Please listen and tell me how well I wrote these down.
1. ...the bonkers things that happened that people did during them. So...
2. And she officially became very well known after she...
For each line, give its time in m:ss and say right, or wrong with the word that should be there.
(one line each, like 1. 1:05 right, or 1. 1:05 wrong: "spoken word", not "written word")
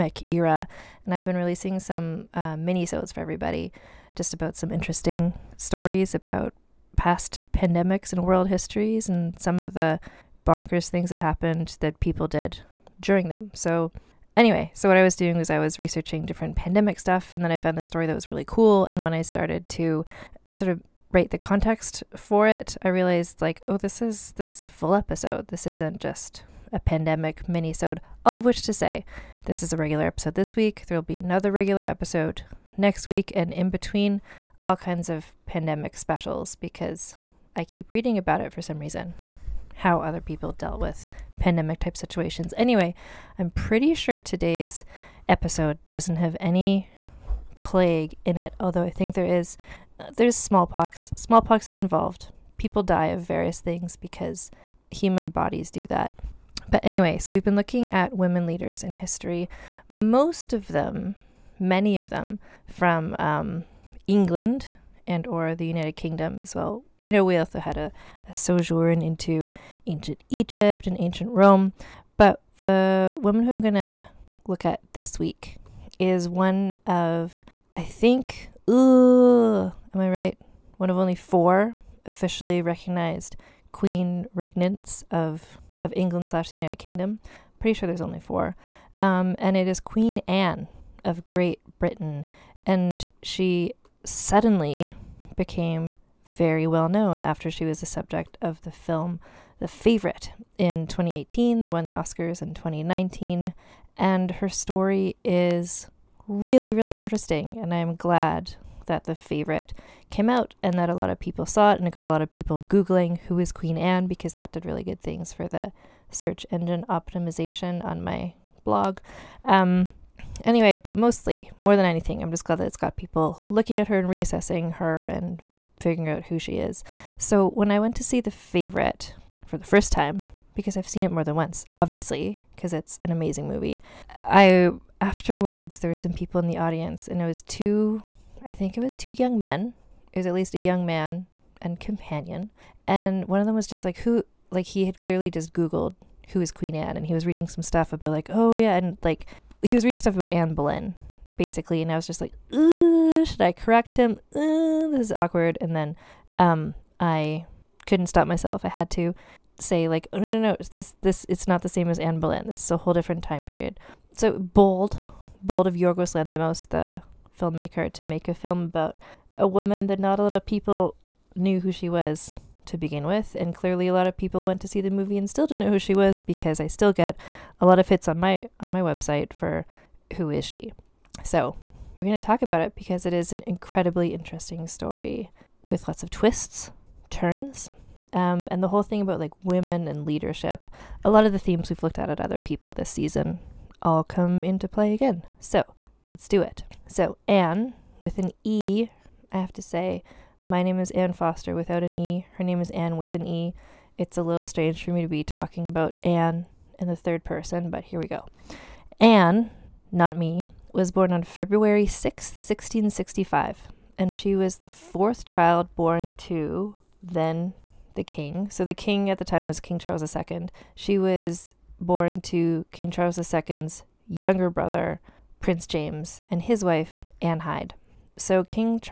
1. 0:09 right
2. 1:32 wrong: "suddenly", not "officially".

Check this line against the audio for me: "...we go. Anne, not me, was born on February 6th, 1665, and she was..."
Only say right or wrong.
right.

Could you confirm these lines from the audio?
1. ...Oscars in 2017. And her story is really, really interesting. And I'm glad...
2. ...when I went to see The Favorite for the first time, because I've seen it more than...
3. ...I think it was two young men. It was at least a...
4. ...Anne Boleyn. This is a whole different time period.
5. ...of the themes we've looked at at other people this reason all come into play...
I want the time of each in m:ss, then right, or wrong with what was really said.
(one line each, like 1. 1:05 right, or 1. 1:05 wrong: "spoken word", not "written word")
1. 1:41 wrong: "2019", not "2017"
2. 2:07 right
3. 2:18 right
4. 2:41 right
5. 3:11 wrong: "season", not "reason".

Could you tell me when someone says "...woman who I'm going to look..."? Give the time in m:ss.
1:13.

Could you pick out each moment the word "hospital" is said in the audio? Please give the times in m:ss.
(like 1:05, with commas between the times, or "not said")
not said.